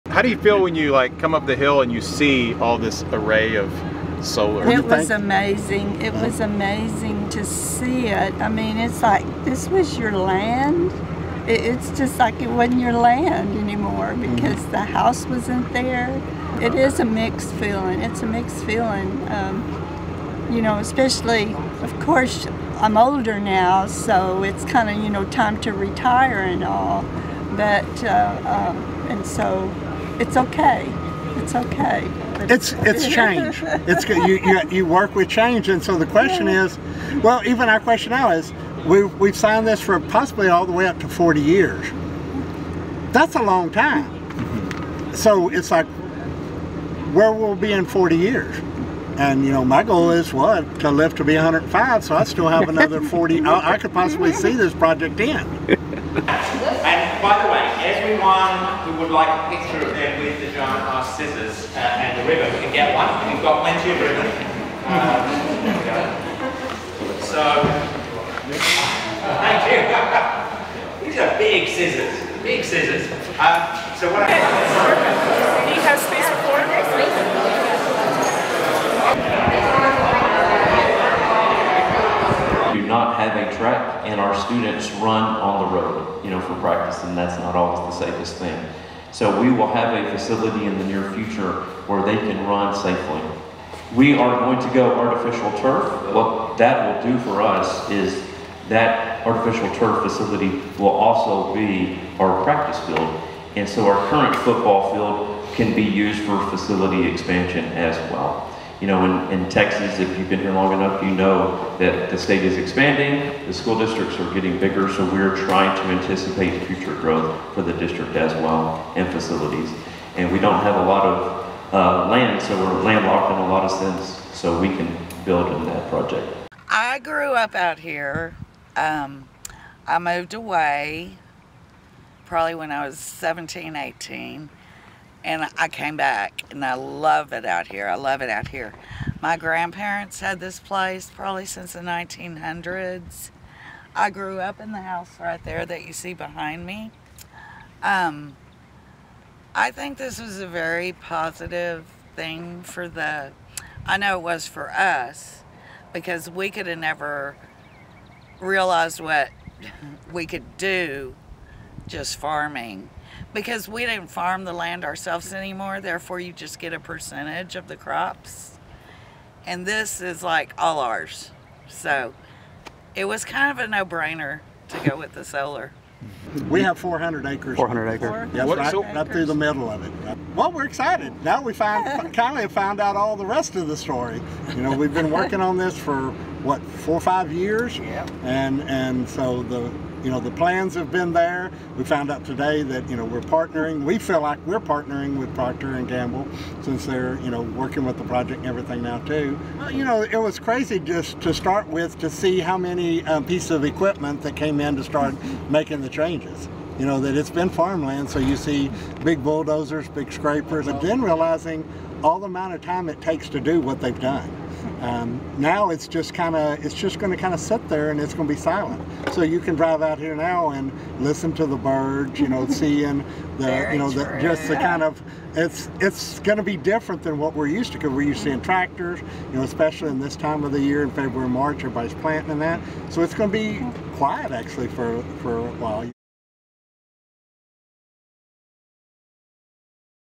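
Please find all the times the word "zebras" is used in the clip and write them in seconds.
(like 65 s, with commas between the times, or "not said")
not said.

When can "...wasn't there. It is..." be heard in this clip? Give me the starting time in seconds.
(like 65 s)
15 s.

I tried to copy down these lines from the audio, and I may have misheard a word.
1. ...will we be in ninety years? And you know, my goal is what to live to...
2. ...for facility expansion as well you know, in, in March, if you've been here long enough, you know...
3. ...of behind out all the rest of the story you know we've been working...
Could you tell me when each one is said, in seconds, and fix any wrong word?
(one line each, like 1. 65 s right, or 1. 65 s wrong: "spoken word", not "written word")
1. 47 s wrong: "forty", not "ninety"
2. 106 s wrong: "Texas", not "March"
3. 182 s wrong: "found", not "behind".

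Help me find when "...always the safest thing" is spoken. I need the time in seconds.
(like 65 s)
87 s.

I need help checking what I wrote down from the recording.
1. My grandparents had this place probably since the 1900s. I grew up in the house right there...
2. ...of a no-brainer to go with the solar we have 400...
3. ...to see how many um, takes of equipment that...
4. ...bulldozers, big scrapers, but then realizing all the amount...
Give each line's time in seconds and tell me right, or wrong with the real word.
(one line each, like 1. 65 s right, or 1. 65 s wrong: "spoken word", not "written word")
1. 139 s right
2. 173 s right
3. 201 s wrong: "pieces", not "takes"
4. 209 s right.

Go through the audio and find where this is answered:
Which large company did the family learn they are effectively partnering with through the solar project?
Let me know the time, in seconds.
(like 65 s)
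195 s.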